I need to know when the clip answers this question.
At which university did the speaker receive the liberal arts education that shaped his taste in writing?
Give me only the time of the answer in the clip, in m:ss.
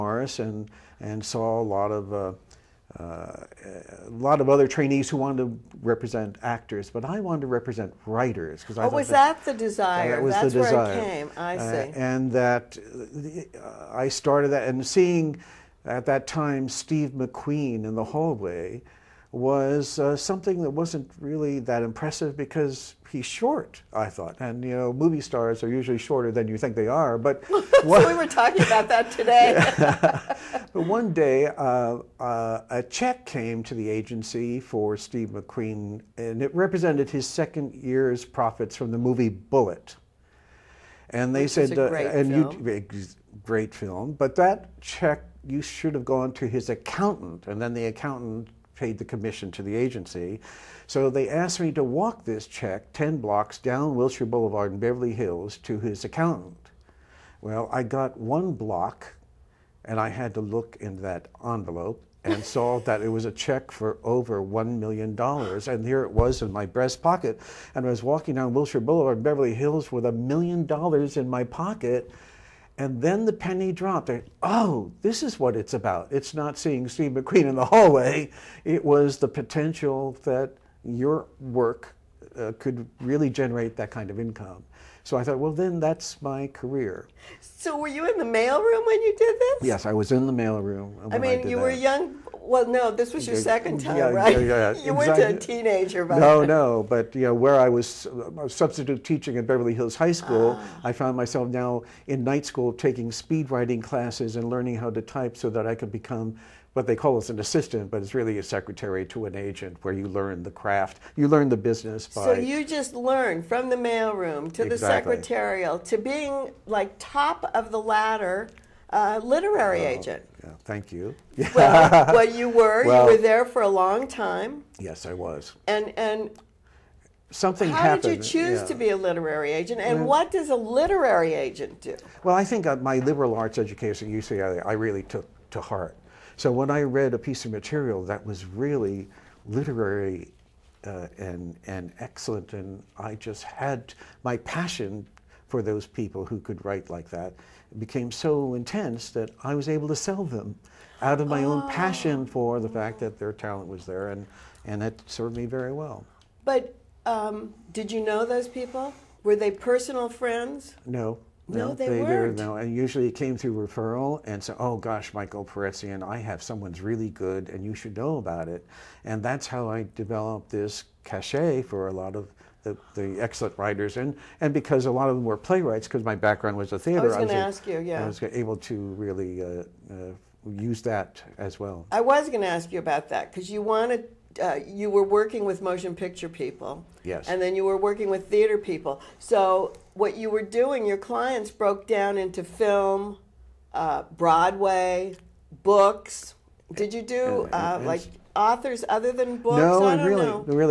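2:14.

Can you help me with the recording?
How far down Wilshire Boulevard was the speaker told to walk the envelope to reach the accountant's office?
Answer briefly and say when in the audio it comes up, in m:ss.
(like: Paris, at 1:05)
10 blocks, at 0:52.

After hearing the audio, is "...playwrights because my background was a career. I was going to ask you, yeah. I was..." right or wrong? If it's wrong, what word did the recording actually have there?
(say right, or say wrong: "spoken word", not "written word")
wrong: "theater", not "career".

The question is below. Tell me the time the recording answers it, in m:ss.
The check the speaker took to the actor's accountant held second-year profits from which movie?
0:39.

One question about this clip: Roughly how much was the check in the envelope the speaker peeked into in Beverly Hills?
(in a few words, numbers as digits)
Over $1 million.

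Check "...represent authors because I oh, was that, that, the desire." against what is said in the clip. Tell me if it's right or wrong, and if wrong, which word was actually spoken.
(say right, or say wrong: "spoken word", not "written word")
wrong: "writers", not "authors".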